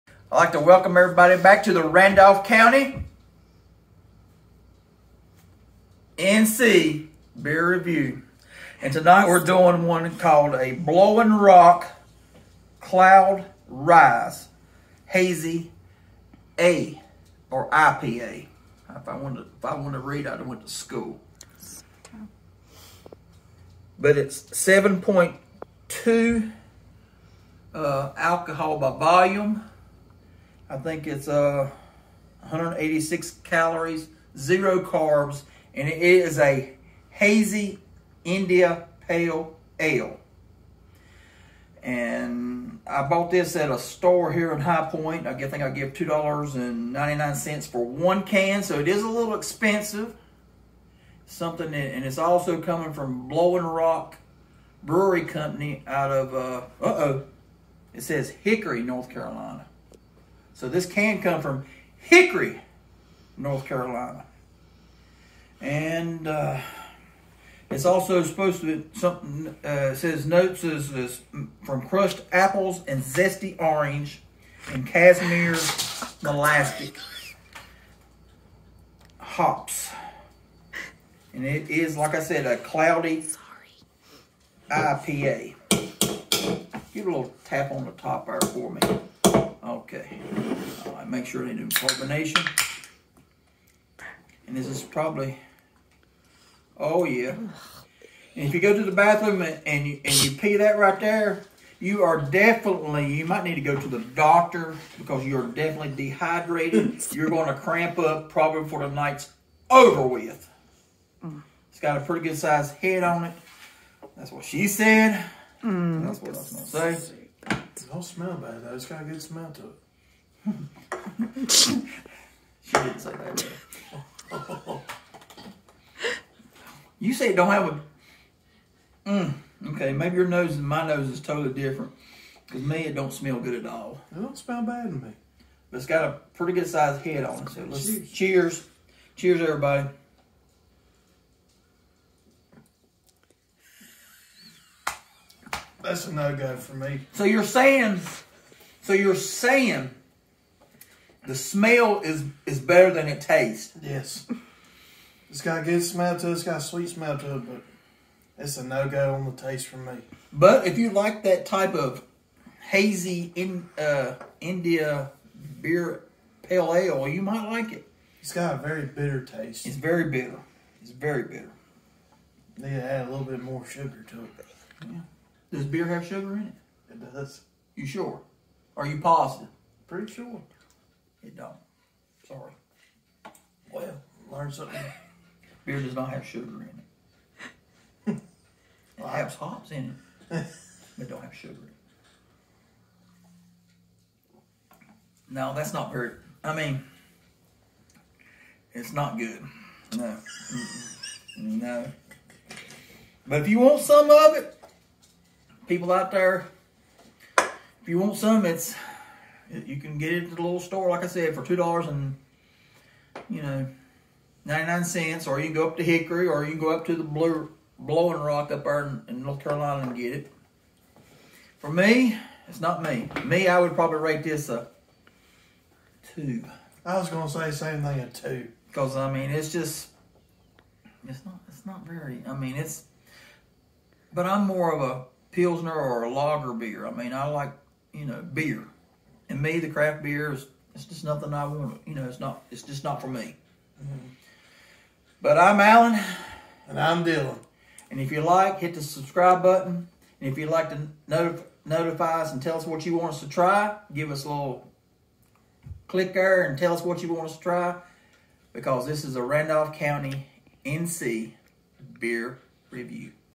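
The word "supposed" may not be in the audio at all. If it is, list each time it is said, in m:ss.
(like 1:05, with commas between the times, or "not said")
1:08.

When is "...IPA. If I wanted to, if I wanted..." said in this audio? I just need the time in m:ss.
0:17.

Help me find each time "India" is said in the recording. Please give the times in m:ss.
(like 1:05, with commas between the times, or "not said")
0:38, 2:44.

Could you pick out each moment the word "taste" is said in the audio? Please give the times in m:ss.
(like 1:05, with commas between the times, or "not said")
2:33, 2:39, 2:49.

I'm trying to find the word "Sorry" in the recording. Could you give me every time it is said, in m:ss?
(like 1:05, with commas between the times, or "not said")
1:23, 3:02.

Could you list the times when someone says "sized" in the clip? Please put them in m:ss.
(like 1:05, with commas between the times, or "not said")
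1:52, 2:16.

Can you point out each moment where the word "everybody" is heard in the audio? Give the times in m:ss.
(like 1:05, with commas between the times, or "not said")
0:00, 2:19.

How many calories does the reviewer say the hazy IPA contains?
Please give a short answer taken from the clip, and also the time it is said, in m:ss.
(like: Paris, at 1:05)
186, at 0:32.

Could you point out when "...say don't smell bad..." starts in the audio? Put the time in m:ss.
1:57.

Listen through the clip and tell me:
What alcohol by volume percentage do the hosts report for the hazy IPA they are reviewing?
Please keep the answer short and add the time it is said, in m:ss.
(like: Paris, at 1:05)
7.2, at 0:24.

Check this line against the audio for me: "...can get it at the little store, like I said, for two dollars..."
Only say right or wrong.
right.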